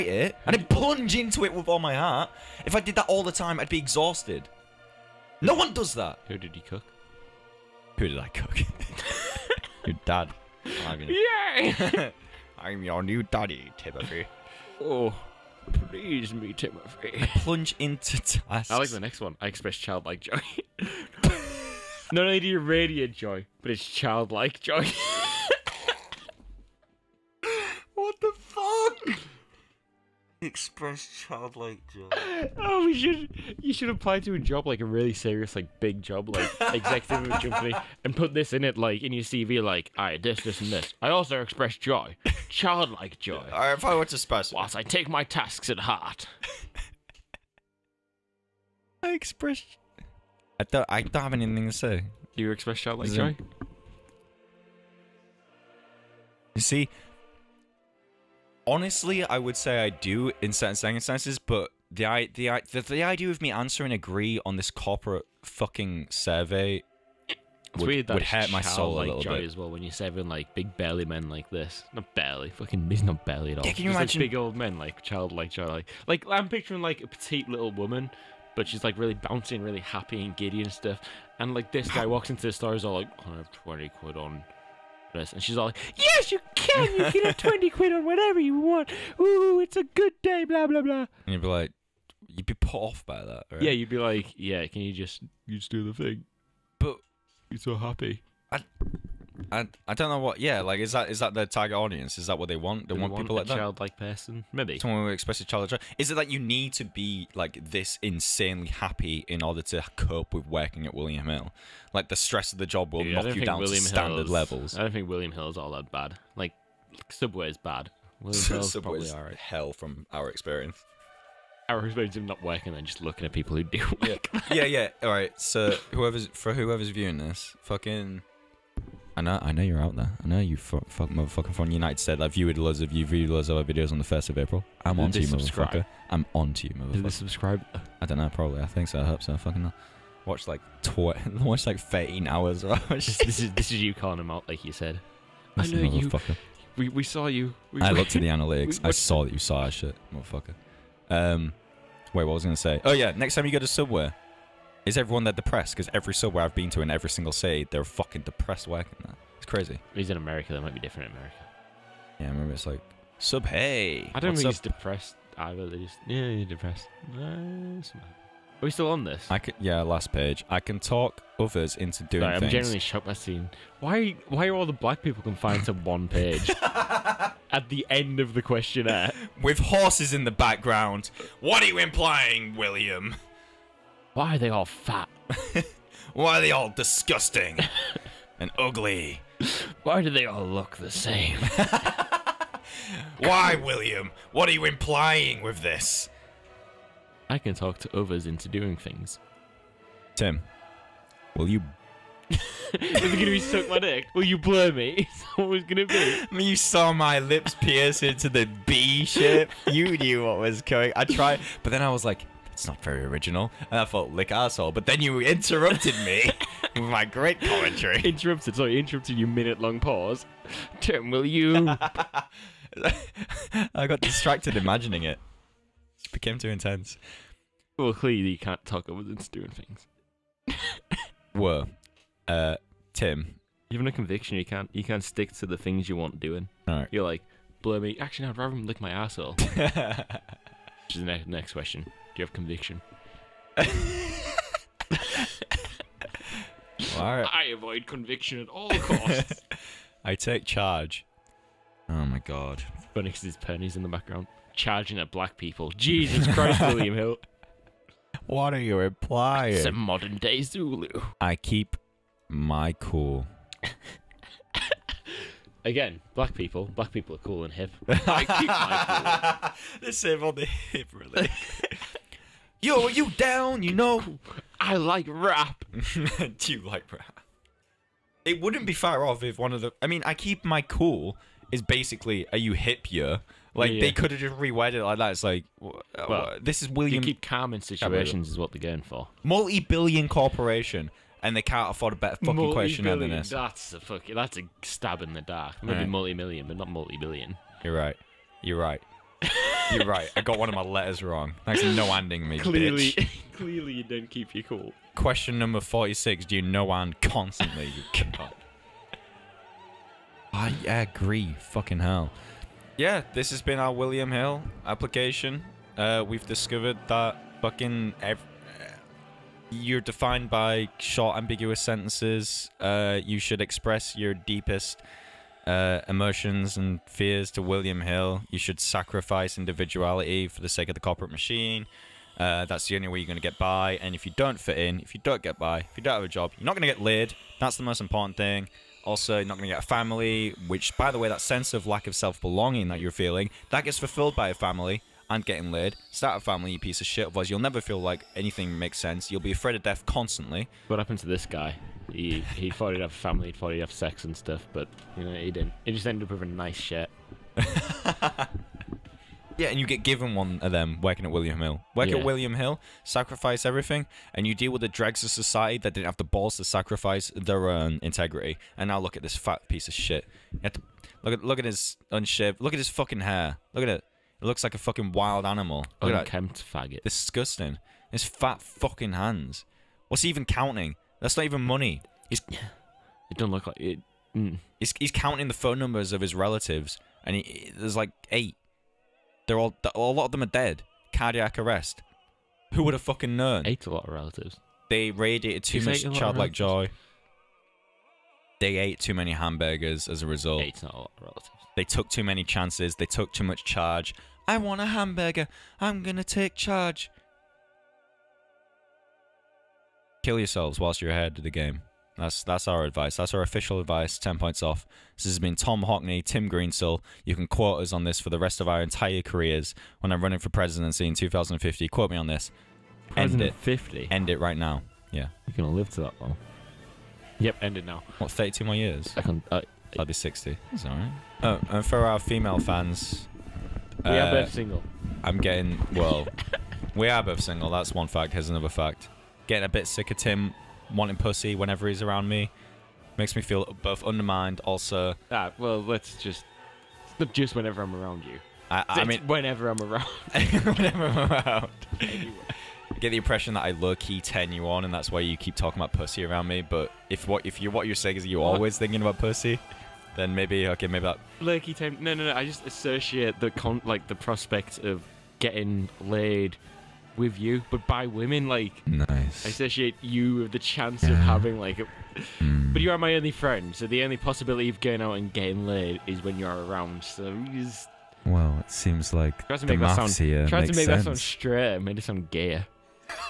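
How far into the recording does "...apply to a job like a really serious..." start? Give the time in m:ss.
0:33.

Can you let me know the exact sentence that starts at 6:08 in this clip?
And now look at this fat piece of shit.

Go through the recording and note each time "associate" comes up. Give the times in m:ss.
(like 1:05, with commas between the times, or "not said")
7:42, 7:49.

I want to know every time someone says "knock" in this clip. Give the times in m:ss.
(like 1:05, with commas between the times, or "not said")
1:53.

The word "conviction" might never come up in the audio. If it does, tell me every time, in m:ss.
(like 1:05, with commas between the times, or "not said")
3:53, 4:02, 4:07.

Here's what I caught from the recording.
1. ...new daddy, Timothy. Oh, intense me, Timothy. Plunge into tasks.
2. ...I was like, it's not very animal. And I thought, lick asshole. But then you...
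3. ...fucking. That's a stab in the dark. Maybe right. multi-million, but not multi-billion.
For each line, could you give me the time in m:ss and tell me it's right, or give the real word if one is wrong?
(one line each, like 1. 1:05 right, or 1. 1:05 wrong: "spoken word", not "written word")
1. 0:13 wrong: "please", not "intense"
2. 3:31 wrong: "original", not "animal"
3. 4:53 right.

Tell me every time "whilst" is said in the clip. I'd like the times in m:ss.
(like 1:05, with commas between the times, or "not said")
0:44, 6:50.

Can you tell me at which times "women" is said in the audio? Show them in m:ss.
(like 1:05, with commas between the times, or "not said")
7:47.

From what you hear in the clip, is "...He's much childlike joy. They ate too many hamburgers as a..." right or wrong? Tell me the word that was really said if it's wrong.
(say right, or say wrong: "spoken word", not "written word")
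right.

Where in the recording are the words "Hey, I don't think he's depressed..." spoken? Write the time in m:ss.
2:43.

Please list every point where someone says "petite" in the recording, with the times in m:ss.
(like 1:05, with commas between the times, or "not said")
1:17.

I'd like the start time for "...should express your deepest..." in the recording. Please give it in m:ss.
5:23.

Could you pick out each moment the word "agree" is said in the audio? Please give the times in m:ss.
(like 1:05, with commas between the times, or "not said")
1:03, 5:10.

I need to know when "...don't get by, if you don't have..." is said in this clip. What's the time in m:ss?
5:35.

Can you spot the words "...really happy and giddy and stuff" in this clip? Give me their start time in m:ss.
1:19.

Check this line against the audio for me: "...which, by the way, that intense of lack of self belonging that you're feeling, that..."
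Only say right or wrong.
wrong.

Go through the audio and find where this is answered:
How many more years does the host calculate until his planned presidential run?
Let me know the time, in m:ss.
7:08.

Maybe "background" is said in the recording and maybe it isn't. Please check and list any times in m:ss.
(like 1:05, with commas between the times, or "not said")
3:00, 4:13.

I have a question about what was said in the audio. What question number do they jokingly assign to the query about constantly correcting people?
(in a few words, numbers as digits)
46.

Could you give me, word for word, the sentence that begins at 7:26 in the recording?
It's just whenever I'm around you.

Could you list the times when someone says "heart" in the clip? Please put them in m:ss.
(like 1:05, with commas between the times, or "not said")
0:01, 0:45.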